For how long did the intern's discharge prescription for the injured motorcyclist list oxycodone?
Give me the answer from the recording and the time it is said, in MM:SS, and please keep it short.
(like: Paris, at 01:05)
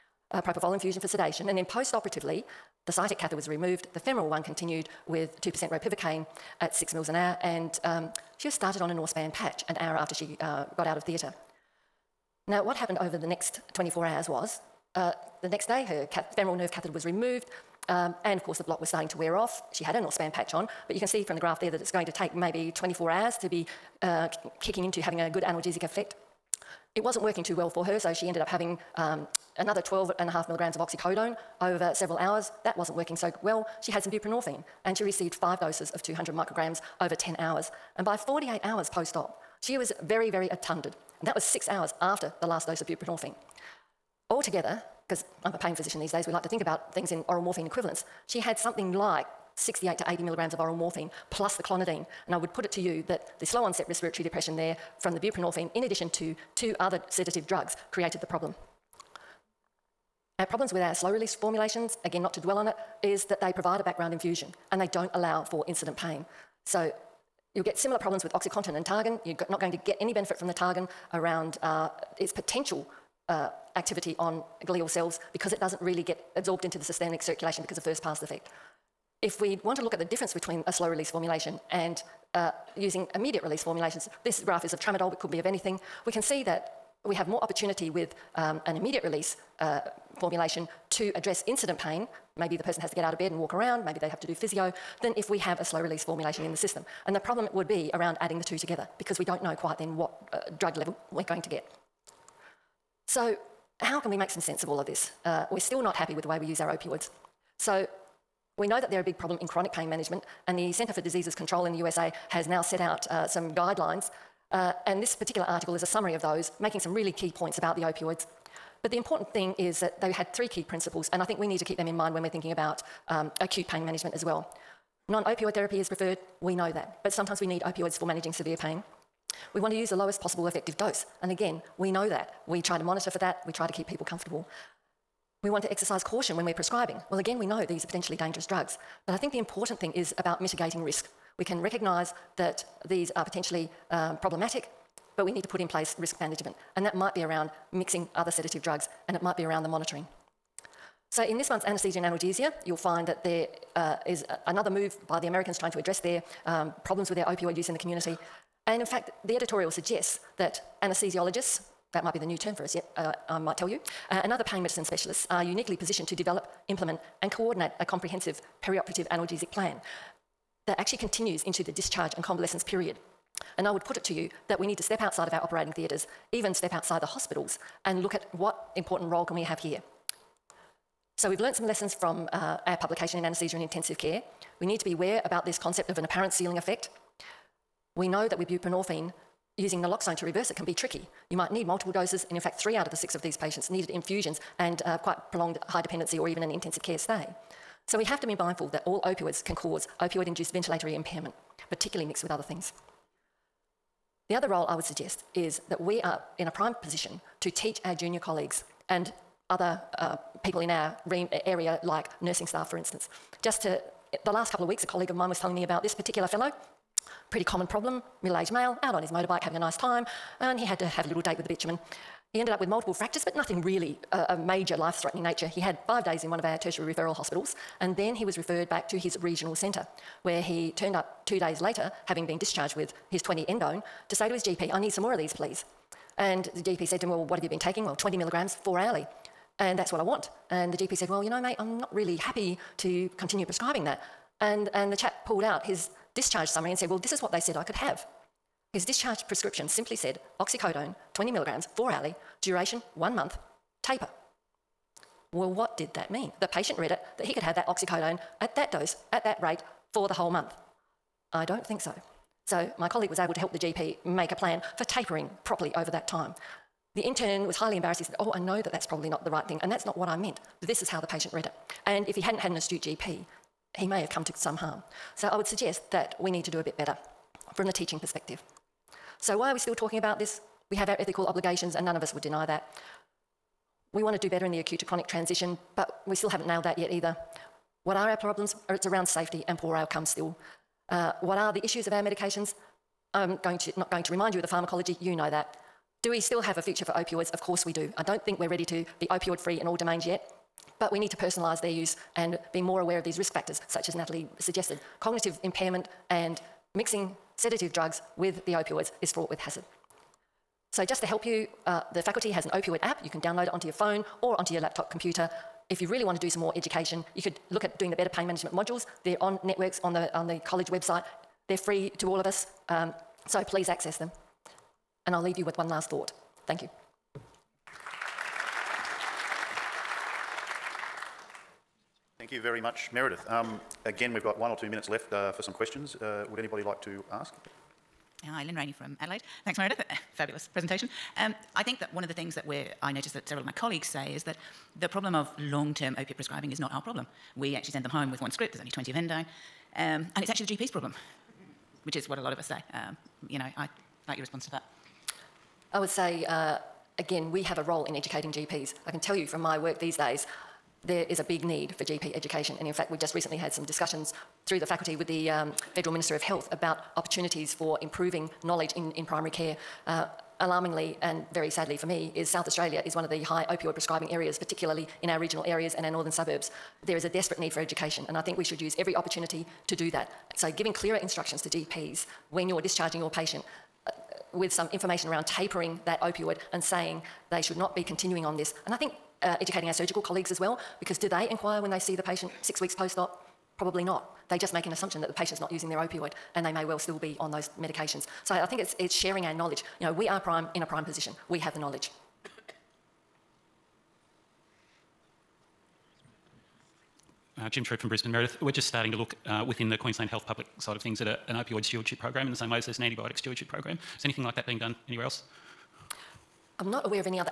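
One month, at 04:12.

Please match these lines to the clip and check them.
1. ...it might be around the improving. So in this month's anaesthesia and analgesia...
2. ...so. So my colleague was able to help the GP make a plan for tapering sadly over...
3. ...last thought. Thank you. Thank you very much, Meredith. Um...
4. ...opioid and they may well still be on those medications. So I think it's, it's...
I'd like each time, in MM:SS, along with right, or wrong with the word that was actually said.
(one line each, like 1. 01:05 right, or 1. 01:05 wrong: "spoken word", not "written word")
1. 02:29 wrong: "monitoring", not "improving"
2. 04:21 wrong: "properly", not "sadly"
3. 05:25 right
4. 06:35 right.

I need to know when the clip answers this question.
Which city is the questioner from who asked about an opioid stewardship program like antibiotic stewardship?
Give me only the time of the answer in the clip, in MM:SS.
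06:47.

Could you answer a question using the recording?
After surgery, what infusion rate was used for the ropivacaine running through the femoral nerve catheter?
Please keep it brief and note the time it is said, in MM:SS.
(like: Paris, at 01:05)
6 ml an hour, at 00:06.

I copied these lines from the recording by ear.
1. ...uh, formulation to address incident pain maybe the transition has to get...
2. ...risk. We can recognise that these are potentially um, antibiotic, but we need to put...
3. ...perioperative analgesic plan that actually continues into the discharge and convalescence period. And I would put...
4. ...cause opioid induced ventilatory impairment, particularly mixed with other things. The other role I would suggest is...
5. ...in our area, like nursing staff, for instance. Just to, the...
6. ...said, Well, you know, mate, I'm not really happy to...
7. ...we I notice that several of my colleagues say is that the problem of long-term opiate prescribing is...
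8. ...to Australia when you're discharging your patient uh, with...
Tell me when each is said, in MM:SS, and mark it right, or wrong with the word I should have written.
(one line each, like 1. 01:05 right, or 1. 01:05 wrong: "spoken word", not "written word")
1. 01:29 wrong: "person", not "transition"
2. 02:20 wrong: "problematic", not "antibiotic"
3. 02:48 right
4. 03:19 right
5. 03:30 right
6. 04:00 right
7. 05:42 right
8. 06:21 wrong: "GPs", not "Australia".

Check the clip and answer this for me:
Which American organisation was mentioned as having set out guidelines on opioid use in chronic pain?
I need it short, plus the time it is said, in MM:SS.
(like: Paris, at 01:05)
Centre for Diseases Control, at 01:50.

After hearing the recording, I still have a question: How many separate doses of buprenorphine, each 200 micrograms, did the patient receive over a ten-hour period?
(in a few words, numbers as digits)
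5.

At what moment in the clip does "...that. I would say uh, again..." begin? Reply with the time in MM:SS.
05:54.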